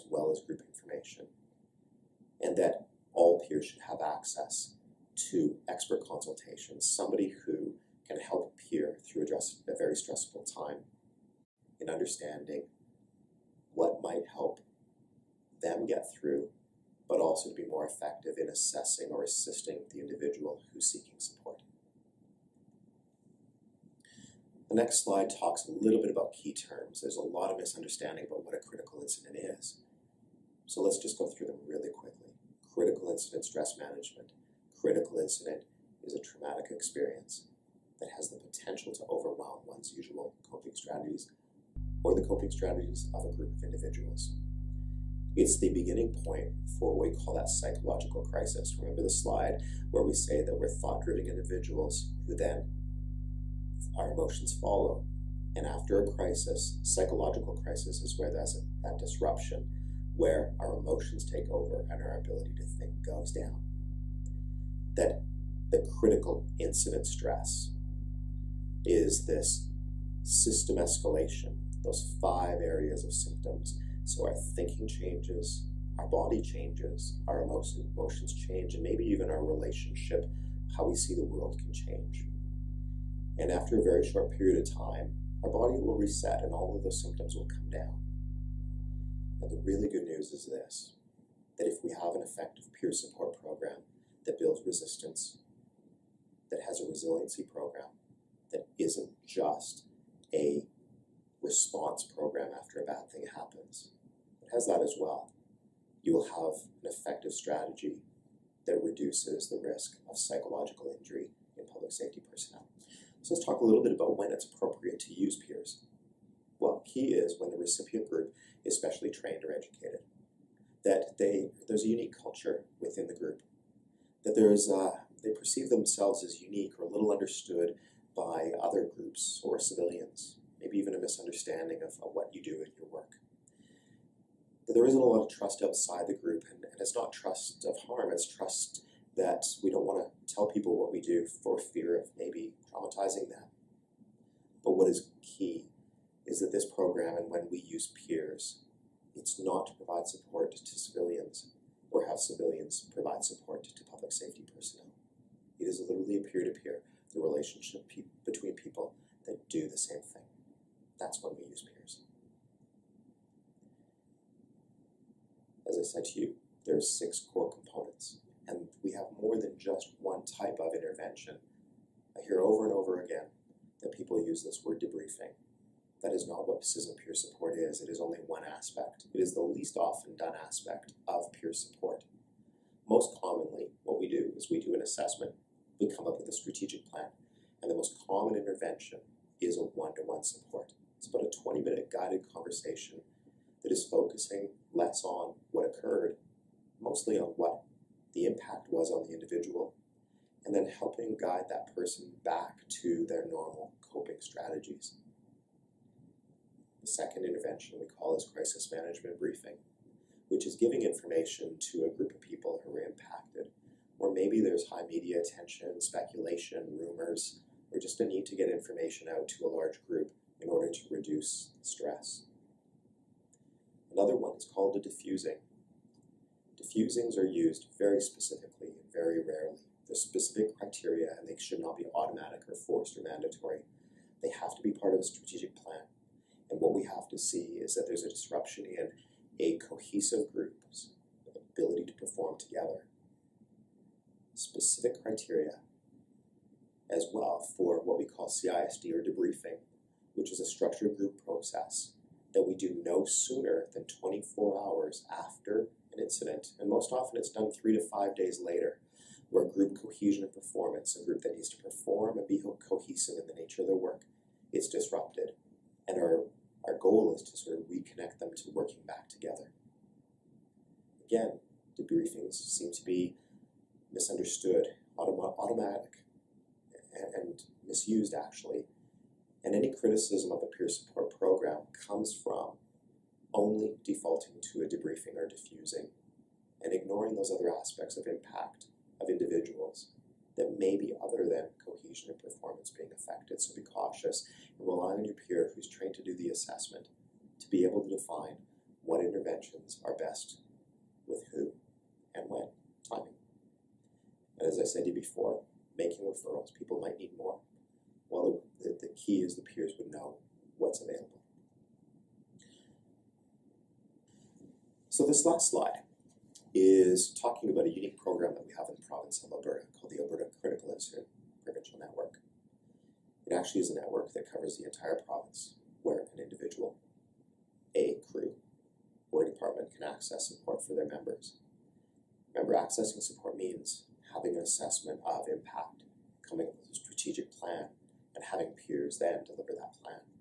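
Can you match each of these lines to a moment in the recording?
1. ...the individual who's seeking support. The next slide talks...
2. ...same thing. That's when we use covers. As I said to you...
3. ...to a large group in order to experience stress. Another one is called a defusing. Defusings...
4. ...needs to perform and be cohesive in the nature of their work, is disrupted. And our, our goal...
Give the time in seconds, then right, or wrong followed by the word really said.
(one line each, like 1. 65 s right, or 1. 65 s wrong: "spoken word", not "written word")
1. 19 s right
2. 159 s wrong: "peers", not "covers"
3. 219 s wrong: "reduce", not "experience"
4. 261 s right.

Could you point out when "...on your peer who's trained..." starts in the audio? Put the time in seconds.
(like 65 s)
294 s.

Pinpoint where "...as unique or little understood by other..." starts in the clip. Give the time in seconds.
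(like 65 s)
126 s.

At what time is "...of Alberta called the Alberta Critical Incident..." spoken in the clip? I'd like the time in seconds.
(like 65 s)
319 s.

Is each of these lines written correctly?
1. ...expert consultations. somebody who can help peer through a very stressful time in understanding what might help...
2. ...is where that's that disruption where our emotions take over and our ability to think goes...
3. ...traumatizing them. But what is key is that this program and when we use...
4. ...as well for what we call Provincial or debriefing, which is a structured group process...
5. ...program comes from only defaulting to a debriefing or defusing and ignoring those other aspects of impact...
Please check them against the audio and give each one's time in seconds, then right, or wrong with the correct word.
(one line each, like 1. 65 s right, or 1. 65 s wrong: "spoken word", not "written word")
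1. 5 s right
2. 58 s right
3. 142 s right
4. 246 s wrong: "CISD", not "Provincial"
5. 281 s right.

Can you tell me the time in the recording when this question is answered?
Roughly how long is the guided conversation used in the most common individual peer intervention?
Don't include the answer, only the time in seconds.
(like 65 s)
191 s.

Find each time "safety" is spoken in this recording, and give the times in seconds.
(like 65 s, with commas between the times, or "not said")
111 s, 154 s.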